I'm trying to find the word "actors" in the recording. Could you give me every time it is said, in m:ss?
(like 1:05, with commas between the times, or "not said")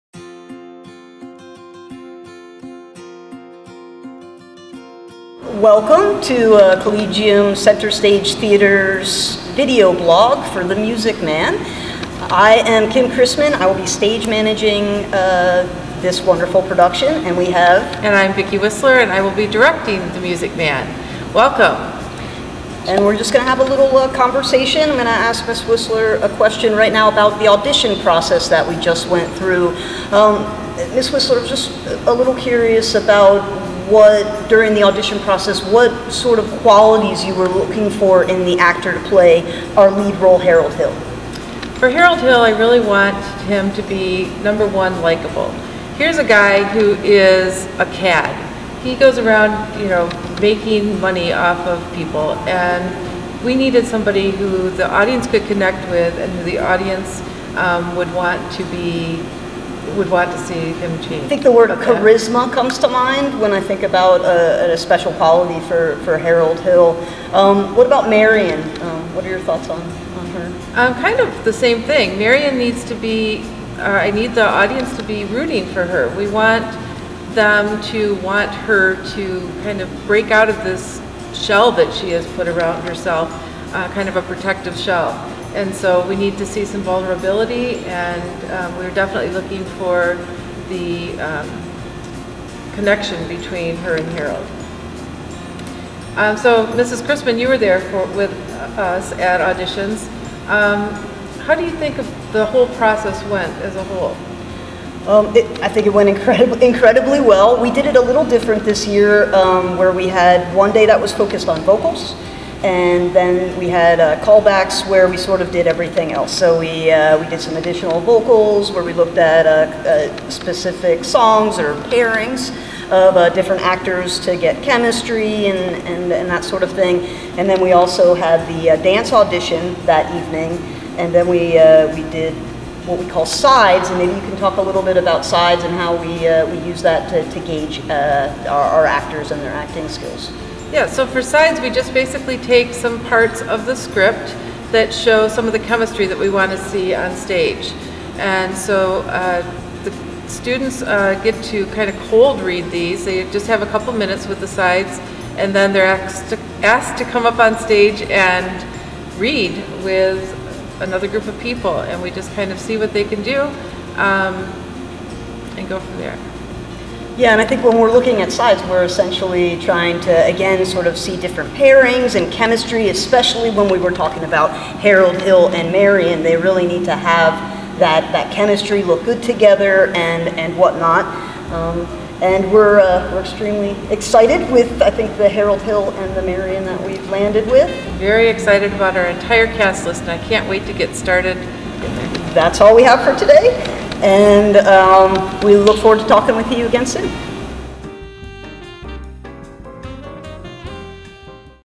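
0:38, 2:03, 2:18.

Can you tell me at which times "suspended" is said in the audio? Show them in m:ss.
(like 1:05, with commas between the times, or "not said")
not said.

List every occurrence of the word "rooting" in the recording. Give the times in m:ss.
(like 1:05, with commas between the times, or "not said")
1:15.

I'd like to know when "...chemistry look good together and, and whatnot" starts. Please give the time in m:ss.
2:58.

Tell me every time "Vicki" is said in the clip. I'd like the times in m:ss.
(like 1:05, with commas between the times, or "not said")
0:18.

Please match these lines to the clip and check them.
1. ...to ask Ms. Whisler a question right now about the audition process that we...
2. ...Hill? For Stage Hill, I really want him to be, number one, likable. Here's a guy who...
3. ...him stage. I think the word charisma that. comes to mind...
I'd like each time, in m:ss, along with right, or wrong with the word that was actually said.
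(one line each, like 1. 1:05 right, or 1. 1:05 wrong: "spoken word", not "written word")
1. 0:25 right
2. 0:40 wrong: "Harold", not "Stage"
3. 1:00 wrong: "change", not "stage".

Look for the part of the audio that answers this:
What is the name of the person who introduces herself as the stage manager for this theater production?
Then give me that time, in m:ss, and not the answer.
0:12.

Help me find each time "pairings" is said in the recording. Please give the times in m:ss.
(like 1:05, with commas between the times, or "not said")
2:01, 2:51.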